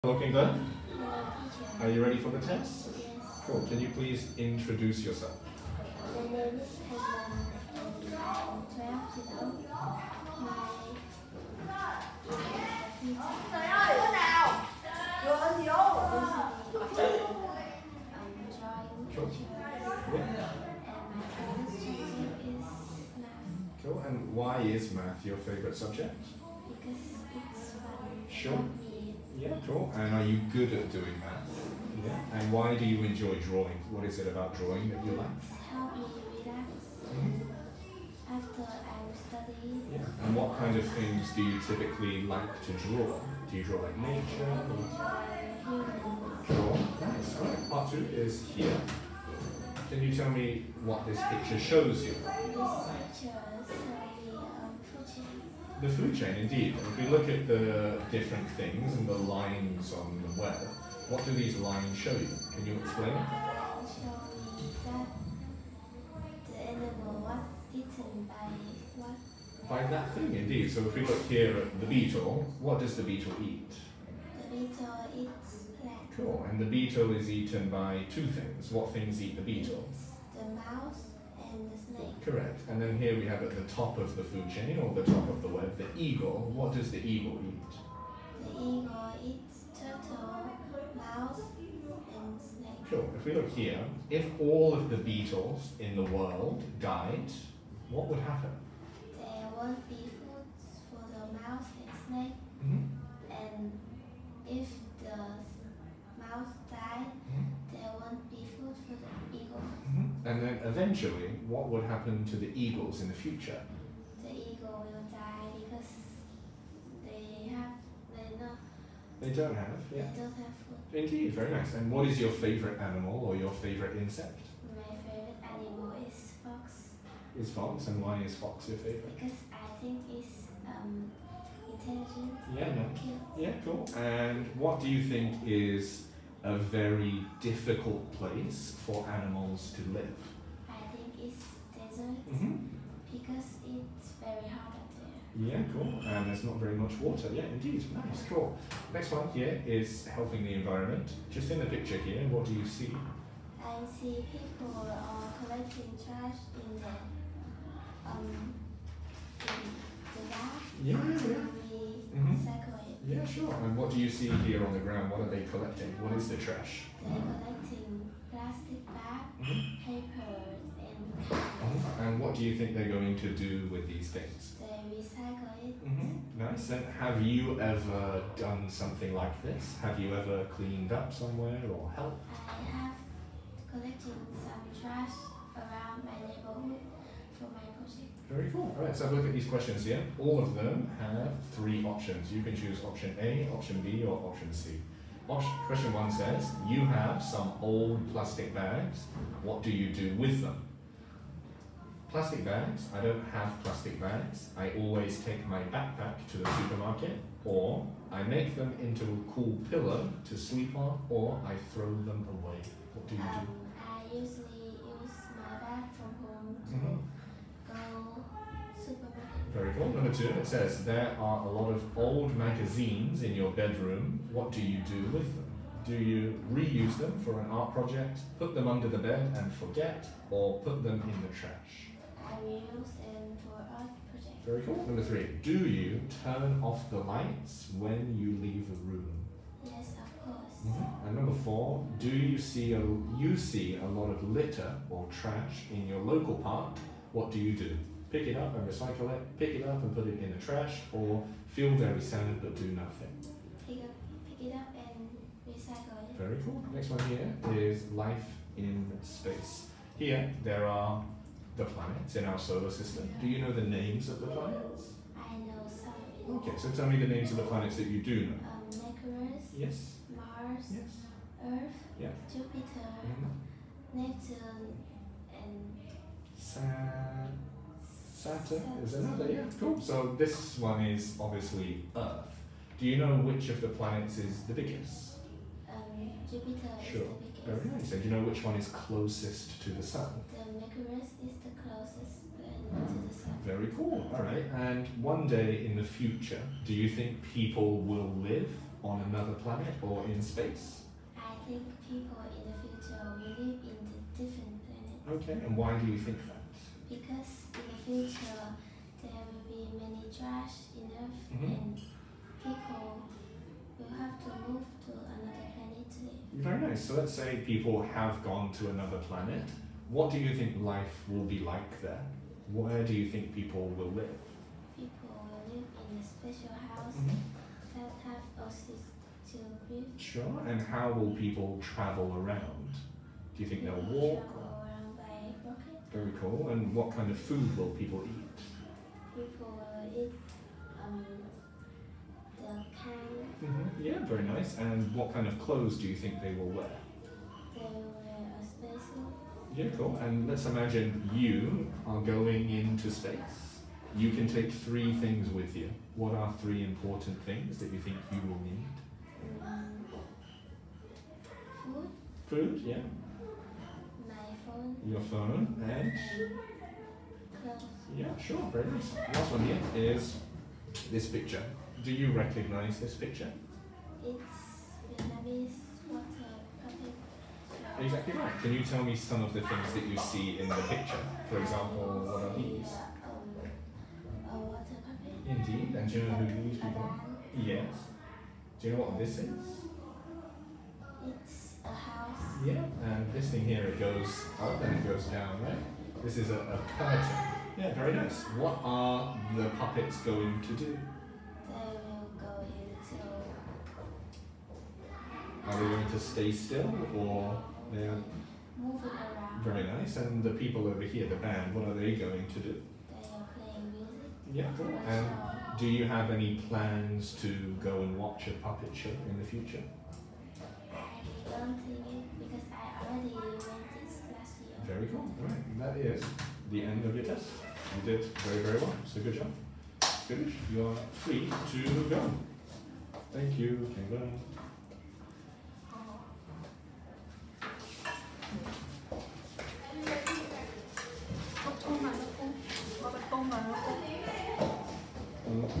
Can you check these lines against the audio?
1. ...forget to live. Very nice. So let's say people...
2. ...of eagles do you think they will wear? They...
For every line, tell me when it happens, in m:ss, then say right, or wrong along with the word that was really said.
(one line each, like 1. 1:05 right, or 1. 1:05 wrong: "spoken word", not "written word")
1. 5:15 wrong: "planet", not "forget"
2. 5:45 wrong: "clothes", not "eagles".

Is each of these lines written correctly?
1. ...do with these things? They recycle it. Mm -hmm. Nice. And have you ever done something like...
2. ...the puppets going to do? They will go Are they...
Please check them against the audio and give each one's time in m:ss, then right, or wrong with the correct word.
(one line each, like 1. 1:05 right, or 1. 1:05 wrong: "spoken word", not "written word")
1. 2:53 right
2. 6:39 right.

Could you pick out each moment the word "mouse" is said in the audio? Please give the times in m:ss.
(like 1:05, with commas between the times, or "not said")
1:20, 1:30, 1:41, 1:46.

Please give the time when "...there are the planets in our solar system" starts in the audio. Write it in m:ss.
4:20.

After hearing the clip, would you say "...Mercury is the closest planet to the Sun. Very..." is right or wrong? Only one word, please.
right.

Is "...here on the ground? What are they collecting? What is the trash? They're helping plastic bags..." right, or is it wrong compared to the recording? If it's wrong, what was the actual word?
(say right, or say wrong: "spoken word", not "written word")
wrong: "collecting", not "helping".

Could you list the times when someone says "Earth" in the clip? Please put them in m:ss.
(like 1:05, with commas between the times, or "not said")
4:31, 4:41, 5:10.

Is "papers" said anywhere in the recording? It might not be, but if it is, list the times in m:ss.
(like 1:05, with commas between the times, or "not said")
2:49.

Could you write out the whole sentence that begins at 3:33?
Um, I usually use my bag from home.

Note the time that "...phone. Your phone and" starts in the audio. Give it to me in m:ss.
6:04.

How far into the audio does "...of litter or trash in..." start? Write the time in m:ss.
4:04.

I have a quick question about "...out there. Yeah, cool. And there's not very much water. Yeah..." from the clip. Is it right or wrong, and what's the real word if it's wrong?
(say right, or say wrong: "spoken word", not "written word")
right.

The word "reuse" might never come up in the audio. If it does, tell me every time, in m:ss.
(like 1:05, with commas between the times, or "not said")
3:46, 3:52.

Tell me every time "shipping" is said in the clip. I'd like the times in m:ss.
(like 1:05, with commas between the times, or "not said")
not said.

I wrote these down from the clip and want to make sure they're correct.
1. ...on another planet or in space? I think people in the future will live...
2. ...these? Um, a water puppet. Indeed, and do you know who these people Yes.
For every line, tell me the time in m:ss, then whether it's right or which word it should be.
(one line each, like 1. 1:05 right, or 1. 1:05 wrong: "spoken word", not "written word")
1. 4:58 right
2. 6:22 right.